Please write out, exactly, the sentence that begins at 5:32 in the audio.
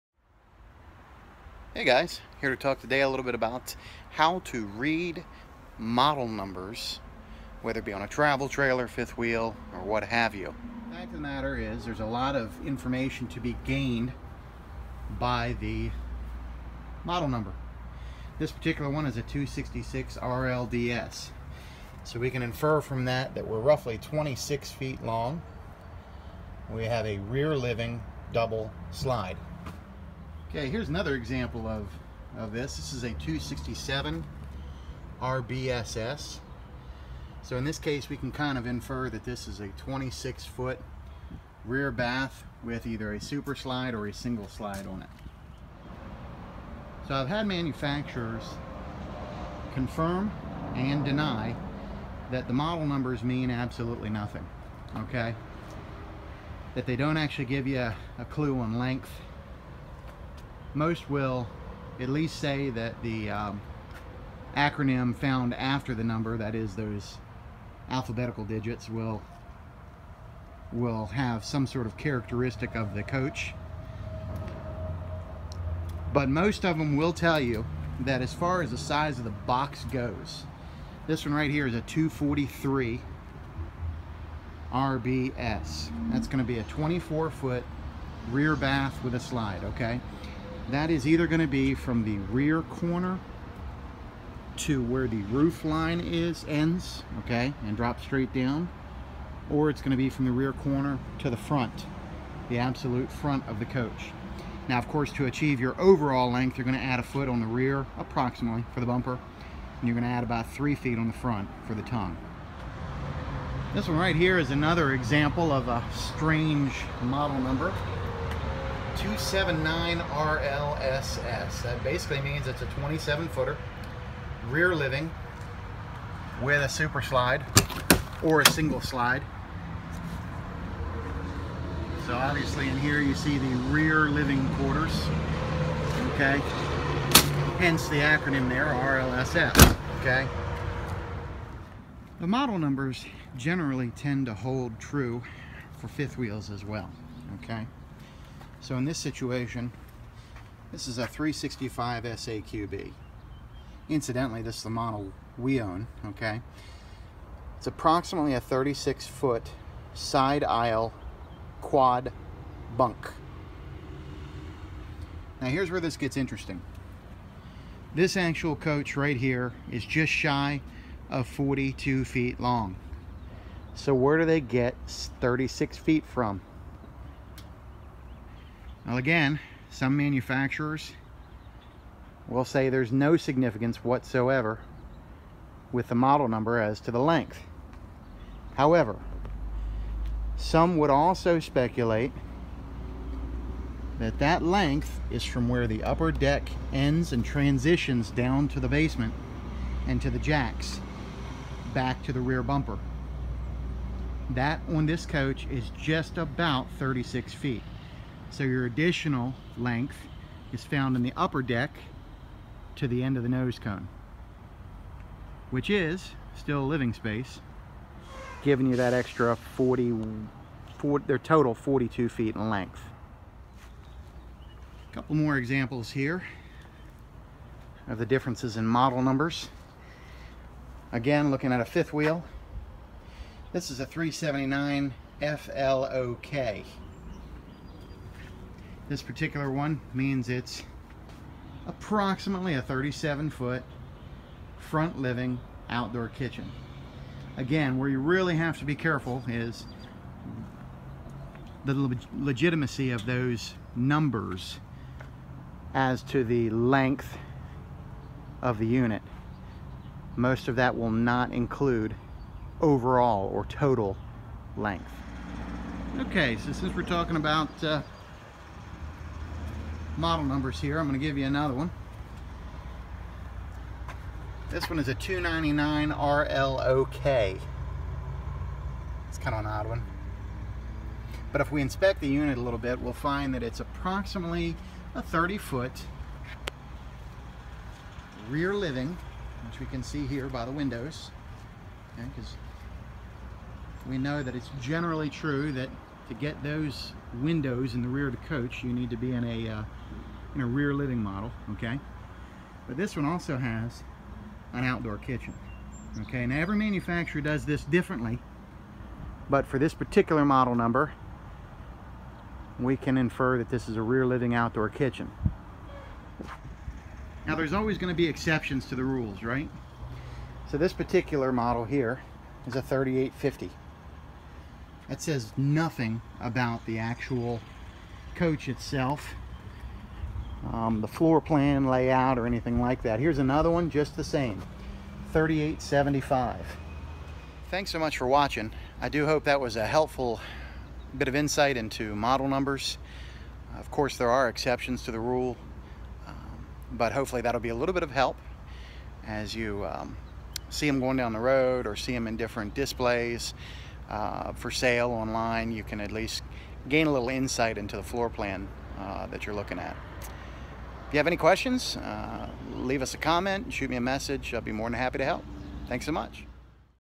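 Here's another one just the same, 3875.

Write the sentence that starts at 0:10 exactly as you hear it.
The fact of the matter is there's a lot of information to be gained by the model number.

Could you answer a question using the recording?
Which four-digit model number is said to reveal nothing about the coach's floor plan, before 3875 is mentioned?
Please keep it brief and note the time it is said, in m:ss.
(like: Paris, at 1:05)
3850, at 5:22.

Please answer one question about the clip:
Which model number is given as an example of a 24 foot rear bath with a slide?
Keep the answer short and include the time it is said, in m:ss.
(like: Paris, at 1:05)
243 RBS, at 1:21.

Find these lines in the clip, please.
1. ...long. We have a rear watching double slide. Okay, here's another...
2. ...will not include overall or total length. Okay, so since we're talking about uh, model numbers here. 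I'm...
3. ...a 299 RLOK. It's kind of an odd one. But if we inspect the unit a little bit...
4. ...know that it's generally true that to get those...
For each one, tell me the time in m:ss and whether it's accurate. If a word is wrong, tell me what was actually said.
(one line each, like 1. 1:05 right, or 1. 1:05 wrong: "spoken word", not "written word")
1. 0:25 wrong: "living", not "watching"
2. 4:20 right
3. 4:34 right
4. 4:53 right.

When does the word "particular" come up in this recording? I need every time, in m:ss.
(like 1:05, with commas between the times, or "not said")
0:18, 3:59, 5:09, 5:20.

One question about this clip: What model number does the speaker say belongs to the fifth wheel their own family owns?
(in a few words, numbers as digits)
365 SAQB.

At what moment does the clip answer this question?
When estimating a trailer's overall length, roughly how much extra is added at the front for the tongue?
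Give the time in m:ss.
1:50.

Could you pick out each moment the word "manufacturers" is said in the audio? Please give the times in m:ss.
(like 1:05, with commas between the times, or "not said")
0:47, 2:59, 5:06.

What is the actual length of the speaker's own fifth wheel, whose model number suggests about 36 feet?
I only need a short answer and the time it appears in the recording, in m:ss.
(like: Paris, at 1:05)
Just shy of 42 feet, at 2:49.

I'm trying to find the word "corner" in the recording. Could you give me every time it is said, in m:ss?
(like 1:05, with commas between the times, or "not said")
1:32, 1:40.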